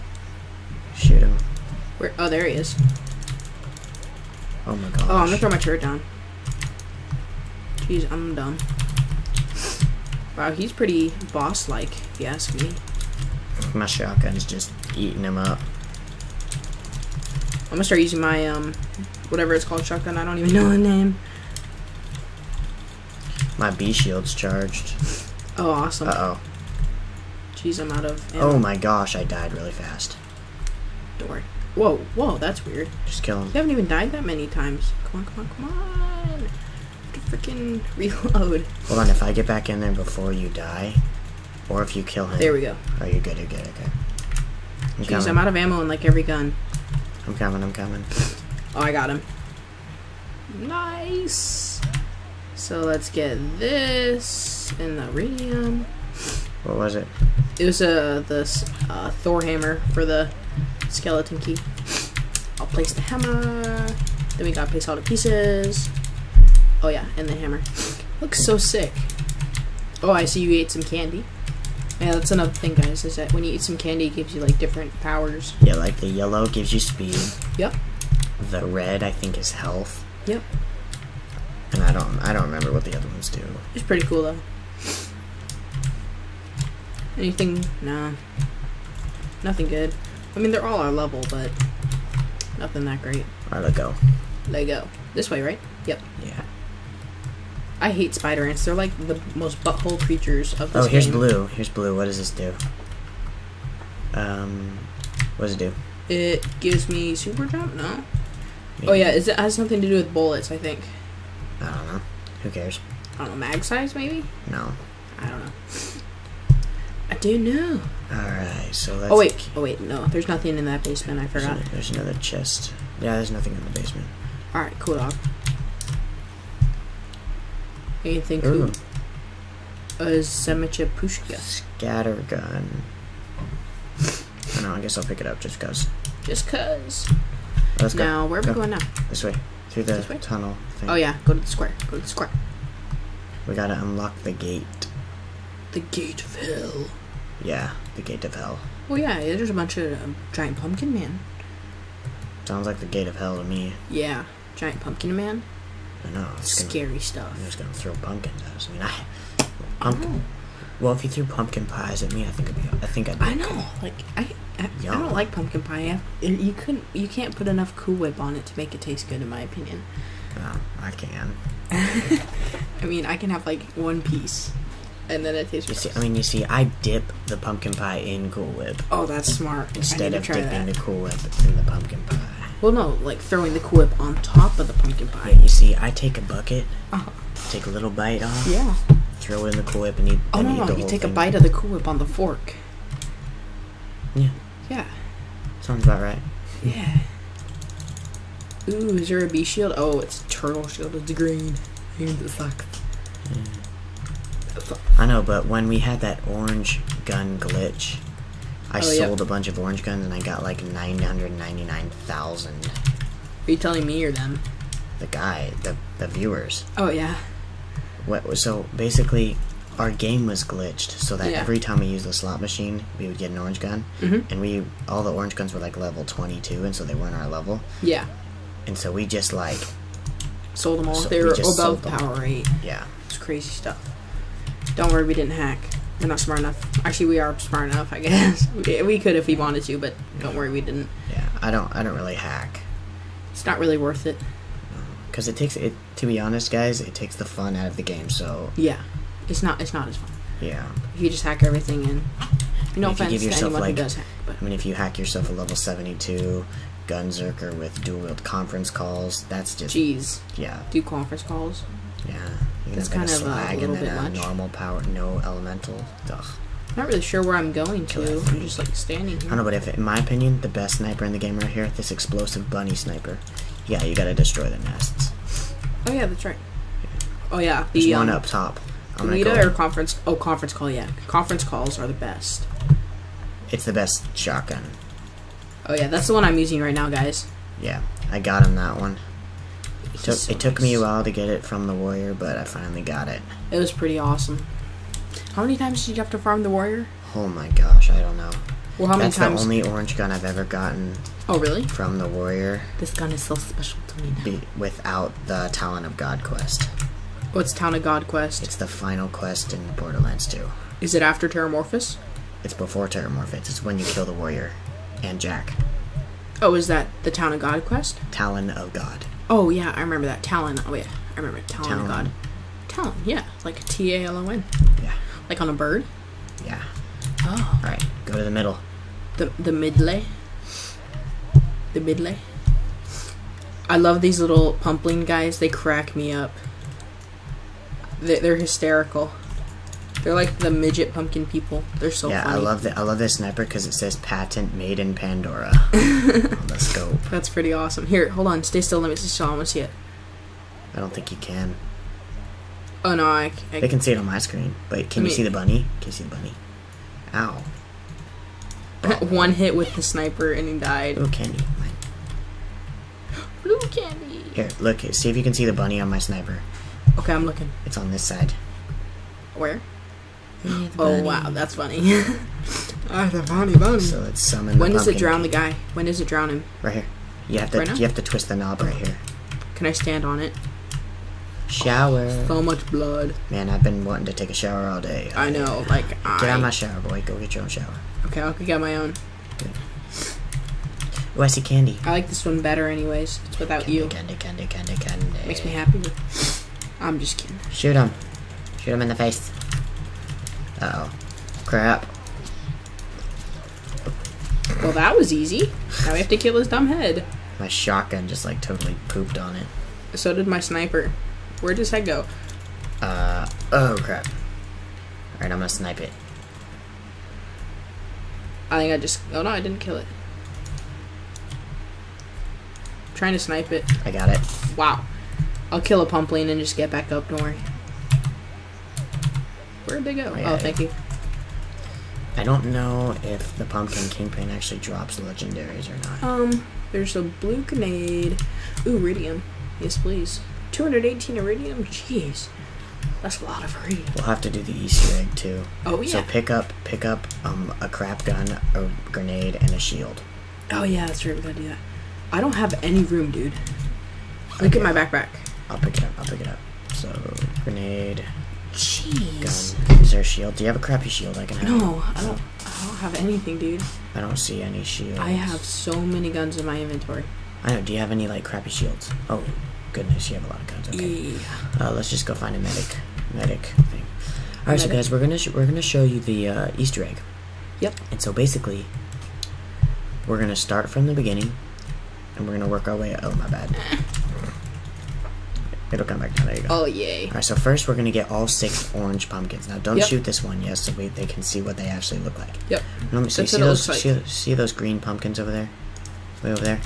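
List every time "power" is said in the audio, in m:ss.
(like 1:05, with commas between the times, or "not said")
1:15, 3:51, 4:24.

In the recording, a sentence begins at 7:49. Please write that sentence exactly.
Oh, goodness, you have a lot of guns.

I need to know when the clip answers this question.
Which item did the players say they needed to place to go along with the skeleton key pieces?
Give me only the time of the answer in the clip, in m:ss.
0:59.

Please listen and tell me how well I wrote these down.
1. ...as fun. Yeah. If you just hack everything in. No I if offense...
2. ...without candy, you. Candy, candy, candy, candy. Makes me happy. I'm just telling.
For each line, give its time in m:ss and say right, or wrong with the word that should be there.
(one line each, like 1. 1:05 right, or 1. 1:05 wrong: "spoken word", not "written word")
1. 4:09 right
2. 6:33 wrong: "kidding", not "telling".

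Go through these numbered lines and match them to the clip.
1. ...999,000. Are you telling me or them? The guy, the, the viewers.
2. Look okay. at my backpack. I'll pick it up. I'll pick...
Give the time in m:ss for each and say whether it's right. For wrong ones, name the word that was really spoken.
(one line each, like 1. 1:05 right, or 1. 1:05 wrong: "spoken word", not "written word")
1. 3:30 right
2. 7:34 right.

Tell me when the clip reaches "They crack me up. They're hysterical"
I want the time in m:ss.
5:35.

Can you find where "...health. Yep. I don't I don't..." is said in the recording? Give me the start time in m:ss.
1:19.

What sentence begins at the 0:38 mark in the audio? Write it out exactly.
Hold on, if I get back in there before you die, or if you kill him.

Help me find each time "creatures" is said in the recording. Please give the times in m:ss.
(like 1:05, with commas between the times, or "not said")
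1:40.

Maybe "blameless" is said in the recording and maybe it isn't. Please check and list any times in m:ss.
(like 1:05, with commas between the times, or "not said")
not said.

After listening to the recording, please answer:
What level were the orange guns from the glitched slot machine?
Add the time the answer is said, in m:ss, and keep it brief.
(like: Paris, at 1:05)
22, at 3:46.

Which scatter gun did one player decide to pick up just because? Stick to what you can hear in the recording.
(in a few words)
Semicha Pushka.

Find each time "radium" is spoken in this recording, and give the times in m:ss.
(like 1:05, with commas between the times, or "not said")
0:55.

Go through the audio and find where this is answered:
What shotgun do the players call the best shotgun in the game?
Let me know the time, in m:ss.
4:40.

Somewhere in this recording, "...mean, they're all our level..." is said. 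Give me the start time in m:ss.
1:30.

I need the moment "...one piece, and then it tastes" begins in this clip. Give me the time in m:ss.
2:53.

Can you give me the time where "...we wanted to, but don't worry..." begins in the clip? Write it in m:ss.
3:59.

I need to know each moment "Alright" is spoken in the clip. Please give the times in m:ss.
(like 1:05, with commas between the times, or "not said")
1:58, 2:04, 6:55, 8:07.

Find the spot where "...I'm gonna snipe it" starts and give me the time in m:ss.
6:55.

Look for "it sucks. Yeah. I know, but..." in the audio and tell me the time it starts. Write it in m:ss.
3:21.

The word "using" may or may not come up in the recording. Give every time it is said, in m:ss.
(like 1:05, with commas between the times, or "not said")
0:18, 4:46.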